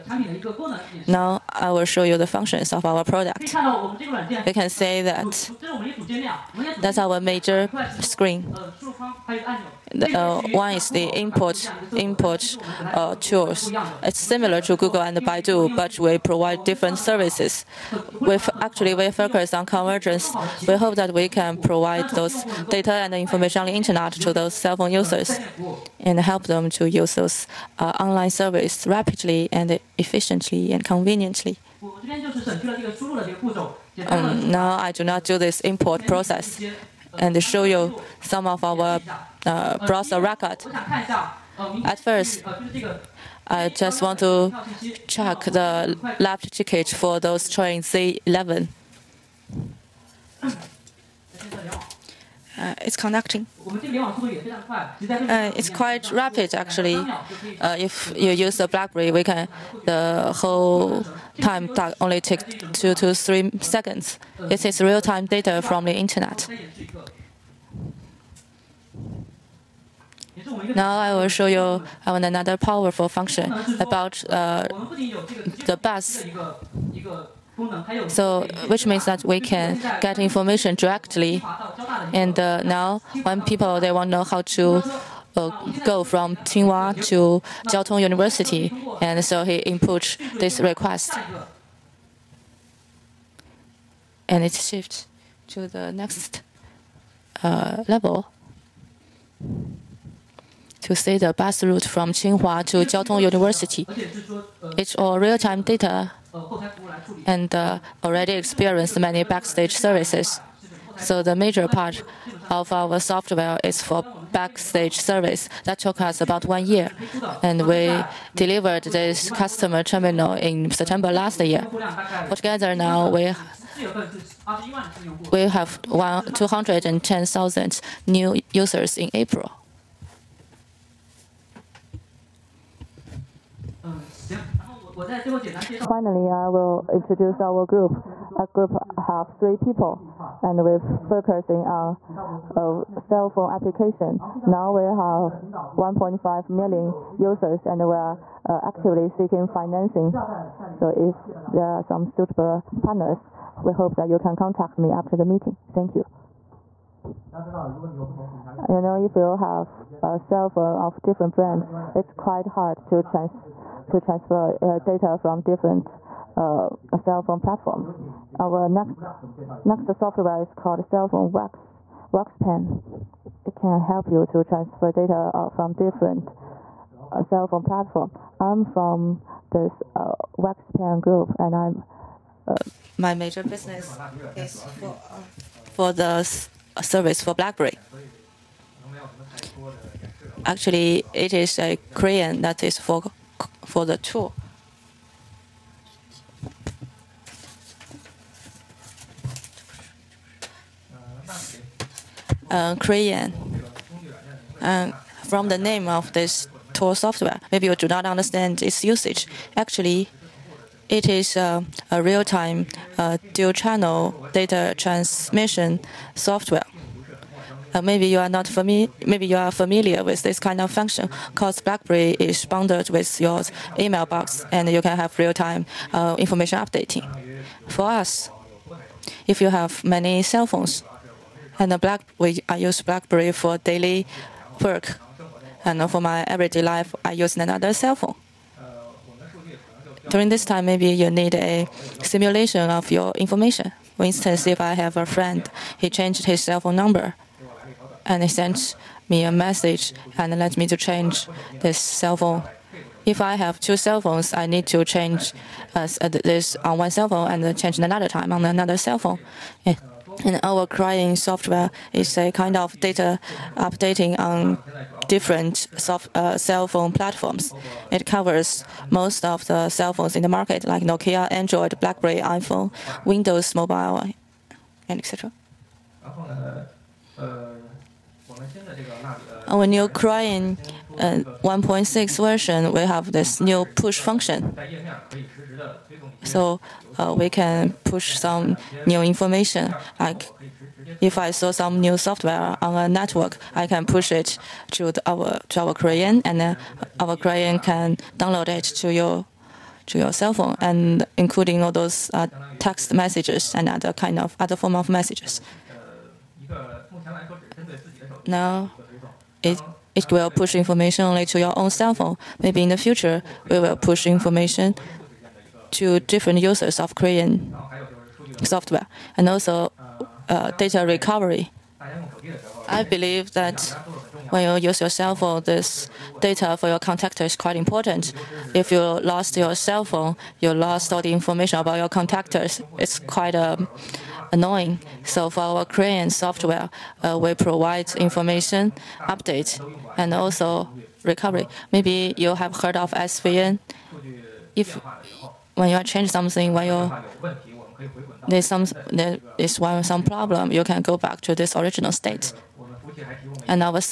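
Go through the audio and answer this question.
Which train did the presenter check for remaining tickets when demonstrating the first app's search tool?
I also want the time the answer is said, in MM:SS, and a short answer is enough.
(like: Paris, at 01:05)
Z11, at 00:47.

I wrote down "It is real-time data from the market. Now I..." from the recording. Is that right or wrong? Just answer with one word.
wrong.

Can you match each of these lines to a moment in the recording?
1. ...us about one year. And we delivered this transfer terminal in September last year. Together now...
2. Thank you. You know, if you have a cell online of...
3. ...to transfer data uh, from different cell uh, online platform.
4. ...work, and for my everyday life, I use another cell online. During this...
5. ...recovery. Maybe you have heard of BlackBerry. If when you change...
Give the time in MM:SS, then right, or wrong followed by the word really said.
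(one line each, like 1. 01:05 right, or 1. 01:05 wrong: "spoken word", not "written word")
1. 01:56 wrong: "customer", not "transfer"
2. 02:35 wrong: "phone", not "online"
3. 02:54 wrong: "phone", not "online"
4. 03:54 wrong: "phone", not "online"
5. 05:41 wrong: "SVN", not "BlackBerry".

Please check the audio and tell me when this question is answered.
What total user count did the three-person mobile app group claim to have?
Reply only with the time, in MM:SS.
02:25.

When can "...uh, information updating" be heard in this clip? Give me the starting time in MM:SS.
03:45.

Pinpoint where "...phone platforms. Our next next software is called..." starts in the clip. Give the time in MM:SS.
02:47.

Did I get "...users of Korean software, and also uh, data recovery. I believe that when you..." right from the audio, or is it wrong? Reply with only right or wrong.
right.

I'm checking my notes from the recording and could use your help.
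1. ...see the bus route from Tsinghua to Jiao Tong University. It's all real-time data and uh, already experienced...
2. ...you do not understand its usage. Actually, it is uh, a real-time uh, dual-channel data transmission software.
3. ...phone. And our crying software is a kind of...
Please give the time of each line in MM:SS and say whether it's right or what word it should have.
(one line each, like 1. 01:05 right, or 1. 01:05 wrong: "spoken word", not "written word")
1. 01:40 right
2. 03:27 right
3. 04:18 right.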